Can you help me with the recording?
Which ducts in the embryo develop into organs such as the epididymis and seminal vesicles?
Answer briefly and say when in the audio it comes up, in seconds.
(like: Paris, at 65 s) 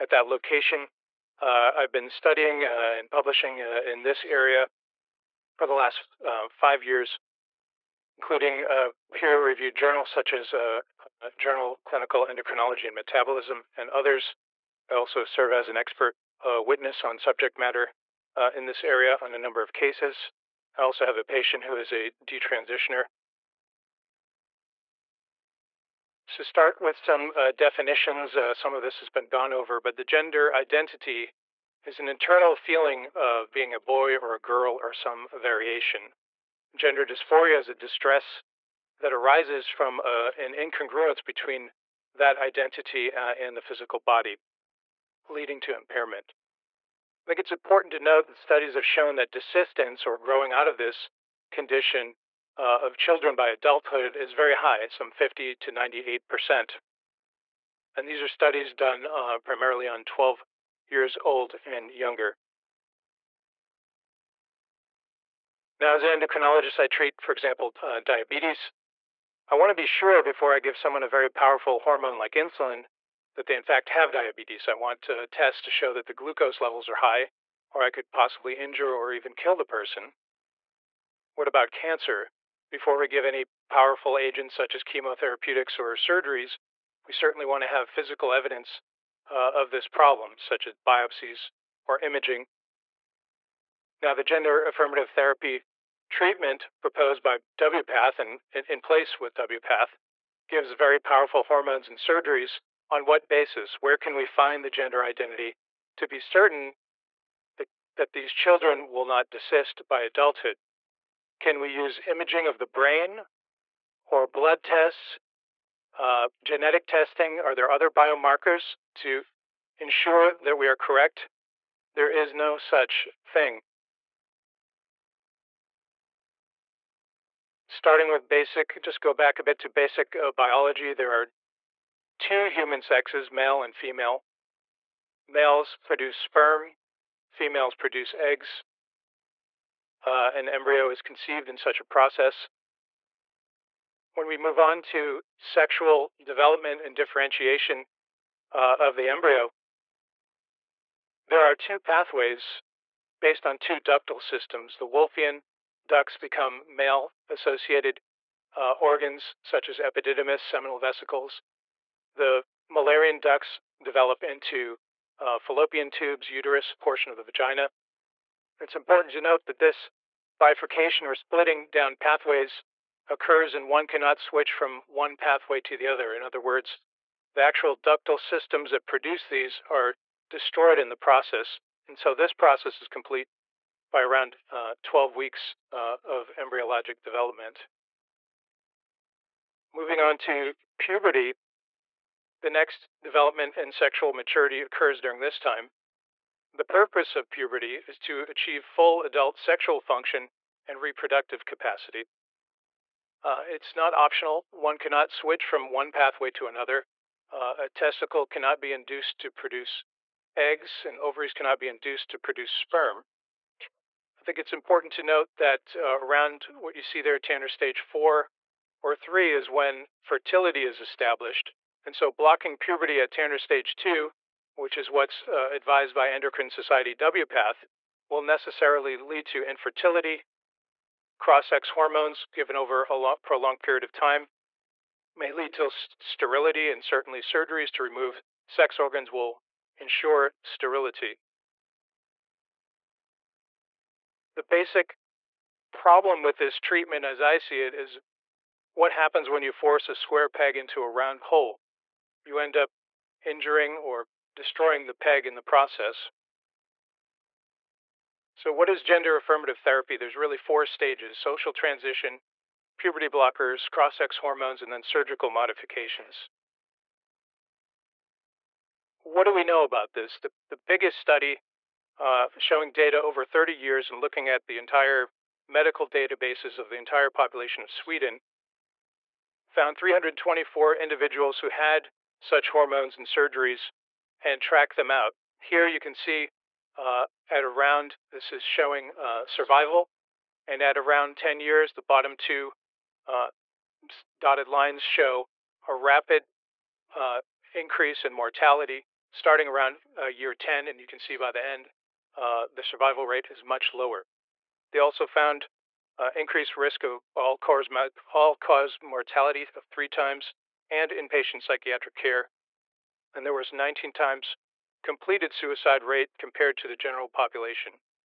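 Wolffian ducts, at 154 s.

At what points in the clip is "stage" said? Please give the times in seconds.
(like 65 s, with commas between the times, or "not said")
217 s, 223 s, 260 s.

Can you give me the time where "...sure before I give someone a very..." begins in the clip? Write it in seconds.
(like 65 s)
69 s.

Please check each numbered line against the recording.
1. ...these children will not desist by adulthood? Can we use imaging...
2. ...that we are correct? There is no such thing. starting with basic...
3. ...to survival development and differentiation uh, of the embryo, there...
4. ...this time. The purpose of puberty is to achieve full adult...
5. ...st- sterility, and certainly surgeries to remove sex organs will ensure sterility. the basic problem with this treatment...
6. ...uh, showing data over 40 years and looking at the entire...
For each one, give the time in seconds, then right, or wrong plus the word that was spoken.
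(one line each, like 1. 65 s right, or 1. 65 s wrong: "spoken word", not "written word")
1. 108 s right
2. 120 s right
3. 144 s wrong: "sexual", not "survival"
4. 195 s right
5. 235 s right
6. 271 s wrong: "30", not "40".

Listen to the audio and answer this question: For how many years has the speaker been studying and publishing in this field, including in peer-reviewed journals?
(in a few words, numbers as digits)
5 years.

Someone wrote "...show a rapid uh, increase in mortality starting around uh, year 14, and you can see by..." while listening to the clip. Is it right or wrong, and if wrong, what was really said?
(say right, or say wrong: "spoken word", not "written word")
wrong: "10", not "14".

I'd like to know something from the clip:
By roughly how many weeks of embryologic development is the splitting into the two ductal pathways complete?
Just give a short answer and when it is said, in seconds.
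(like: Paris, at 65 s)
12 weeks, at 184 s.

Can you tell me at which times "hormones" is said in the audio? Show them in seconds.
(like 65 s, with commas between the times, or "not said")
71 s, 101 s, 231 s, 264 s, 282 s.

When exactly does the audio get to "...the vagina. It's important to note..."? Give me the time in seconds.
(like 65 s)
167 s.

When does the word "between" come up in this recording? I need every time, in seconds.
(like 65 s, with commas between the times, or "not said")
41 s.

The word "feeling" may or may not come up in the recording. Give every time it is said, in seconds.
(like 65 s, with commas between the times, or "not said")
32 s.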